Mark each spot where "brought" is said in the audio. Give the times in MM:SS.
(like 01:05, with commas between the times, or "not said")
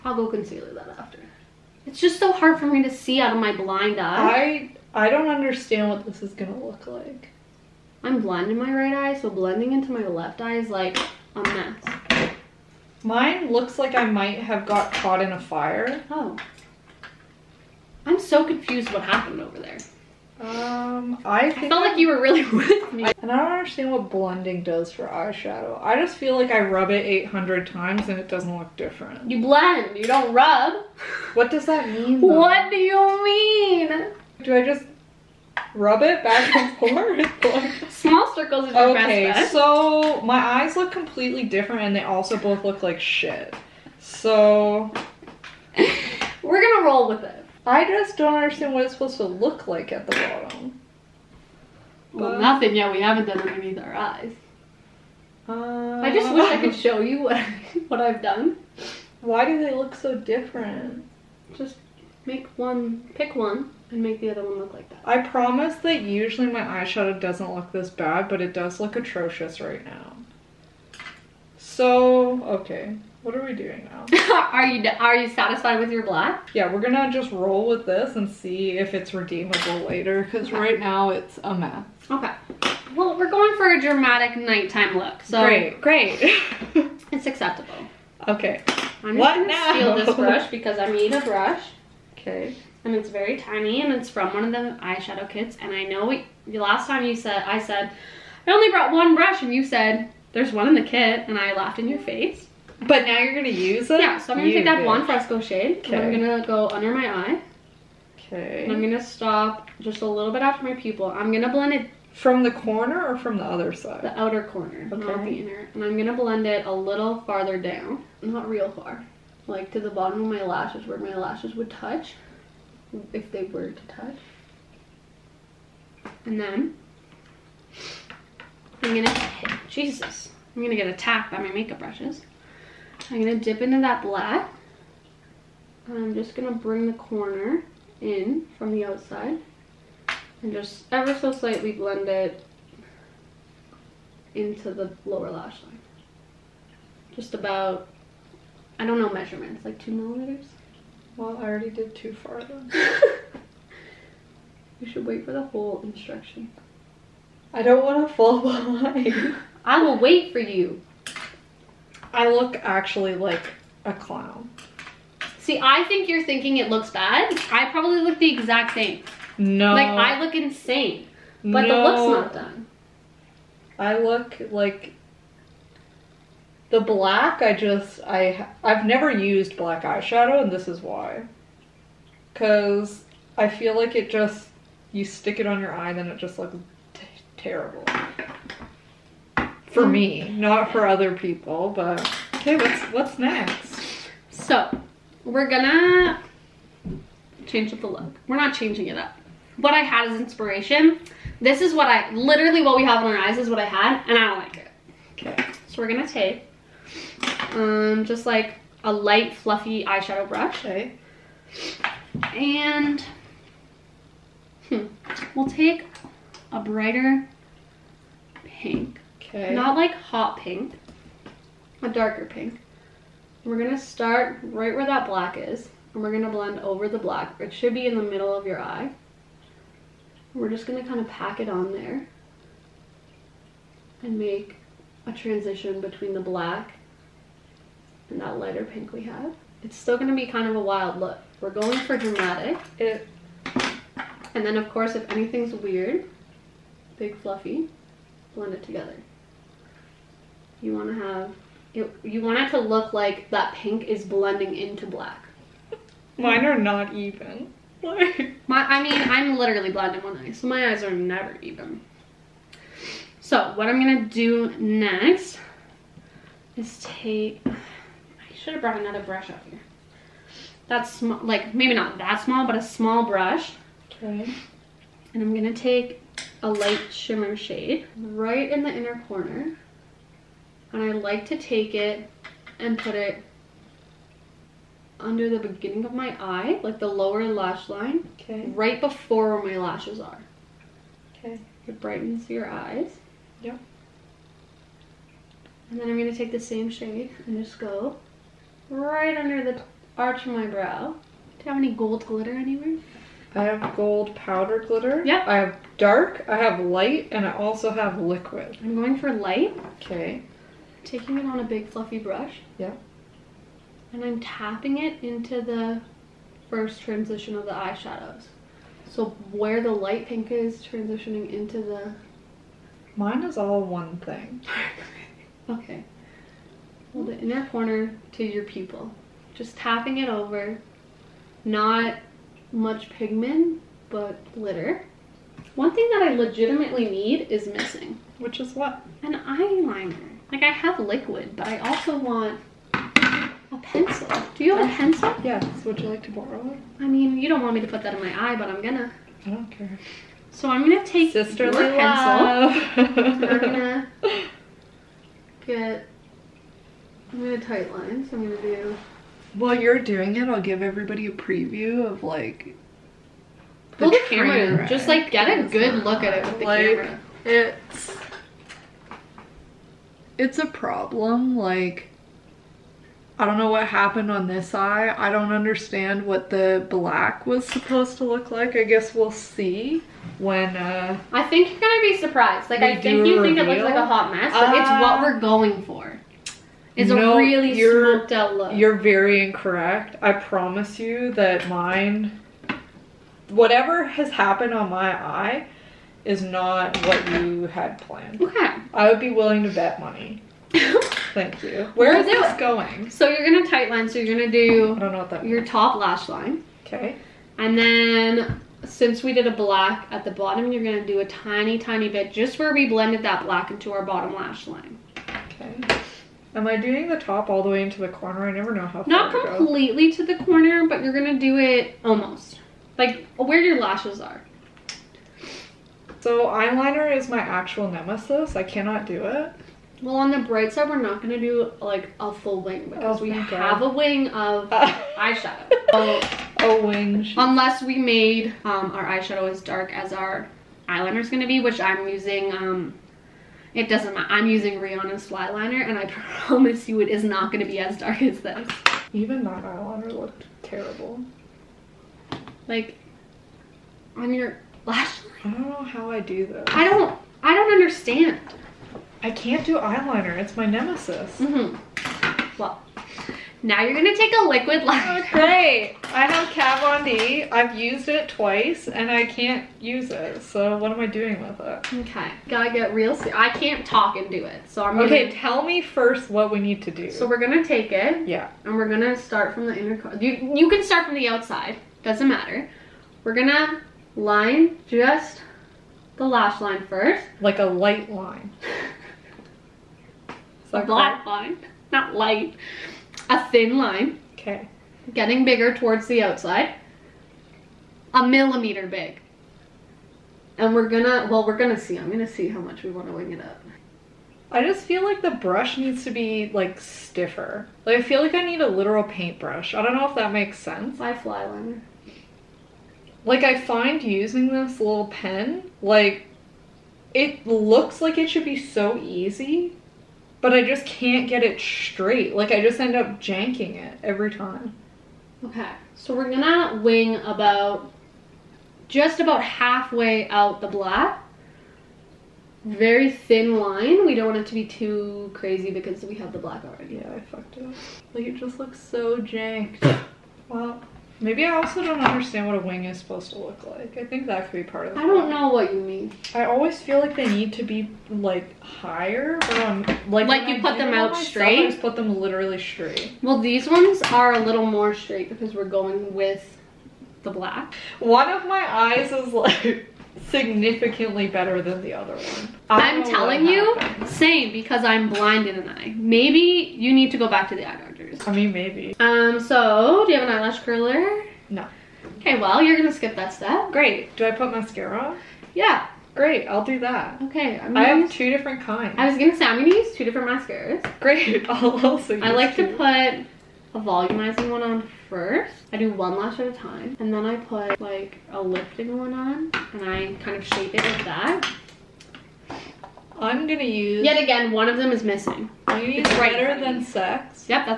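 01:38, 04:28.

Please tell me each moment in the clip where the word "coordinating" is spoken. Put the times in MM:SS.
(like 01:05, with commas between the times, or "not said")
not said.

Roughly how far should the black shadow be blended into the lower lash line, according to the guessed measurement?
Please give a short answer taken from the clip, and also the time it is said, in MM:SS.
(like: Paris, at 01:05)
2 millimeters, at 02:29.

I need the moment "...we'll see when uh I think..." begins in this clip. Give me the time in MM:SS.
06:18.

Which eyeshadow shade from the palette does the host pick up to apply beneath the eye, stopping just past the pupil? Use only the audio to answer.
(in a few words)
blonde fresco.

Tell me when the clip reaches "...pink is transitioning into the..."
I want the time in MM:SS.
05:20.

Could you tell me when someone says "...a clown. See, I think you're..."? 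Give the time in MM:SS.
02:43.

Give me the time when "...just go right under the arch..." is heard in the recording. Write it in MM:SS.
04:57.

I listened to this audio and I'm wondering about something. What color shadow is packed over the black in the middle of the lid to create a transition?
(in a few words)
darker pink.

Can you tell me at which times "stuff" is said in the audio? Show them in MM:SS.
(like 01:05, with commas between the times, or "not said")
not said.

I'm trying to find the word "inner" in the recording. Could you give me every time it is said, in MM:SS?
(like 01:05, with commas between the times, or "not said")
01:55, 04:38, 05:27, 07:59.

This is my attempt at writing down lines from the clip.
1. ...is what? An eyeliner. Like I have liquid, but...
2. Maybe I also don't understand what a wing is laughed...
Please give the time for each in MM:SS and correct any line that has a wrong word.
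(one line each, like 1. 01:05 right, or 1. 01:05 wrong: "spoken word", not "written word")
1. 05:38 right
2. 09:01 wrong: "supposed", not "laughed".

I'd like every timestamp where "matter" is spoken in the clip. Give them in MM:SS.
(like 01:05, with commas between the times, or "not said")
07:23, 08:02.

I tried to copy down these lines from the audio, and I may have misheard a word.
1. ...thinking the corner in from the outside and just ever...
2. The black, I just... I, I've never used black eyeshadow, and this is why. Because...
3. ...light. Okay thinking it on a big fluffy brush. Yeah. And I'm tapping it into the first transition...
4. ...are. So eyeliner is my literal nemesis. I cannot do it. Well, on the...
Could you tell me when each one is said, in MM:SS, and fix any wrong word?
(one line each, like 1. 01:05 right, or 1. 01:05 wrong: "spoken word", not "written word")
1. 02:16 wrong: "bring", not "thinking"
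2. 02:56 right
3. 05:09 wrong: "taking", not "thinking"
4. 07:03 wrong: "actual", not "literal".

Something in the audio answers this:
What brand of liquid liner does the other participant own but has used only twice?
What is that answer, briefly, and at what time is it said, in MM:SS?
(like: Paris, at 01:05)
Kat Von D, at 07:46.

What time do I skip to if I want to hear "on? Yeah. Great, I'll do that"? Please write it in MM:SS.
09:34.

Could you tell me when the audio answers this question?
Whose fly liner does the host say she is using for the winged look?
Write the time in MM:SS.
07:24.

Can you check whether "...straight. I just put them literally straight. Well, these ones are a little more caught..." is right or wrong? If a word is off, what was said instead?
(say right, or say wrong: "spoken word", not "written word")
wrong: "straight", not "caught".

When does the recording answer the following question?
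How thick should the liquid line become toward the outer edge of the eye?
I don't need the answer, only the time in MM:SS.
08:17.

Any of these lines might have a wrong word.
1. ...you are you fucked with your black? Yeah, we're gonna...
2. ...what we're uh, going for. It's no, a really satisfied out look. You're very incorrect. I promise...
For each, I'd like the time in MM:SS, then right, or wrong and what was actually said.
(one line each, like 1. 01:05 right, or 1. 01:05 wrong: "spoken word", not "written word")
1. 01:14 wrong: "satisfied", not "fucked"
2. 06:24 wrong: "smoked", not "satisfied".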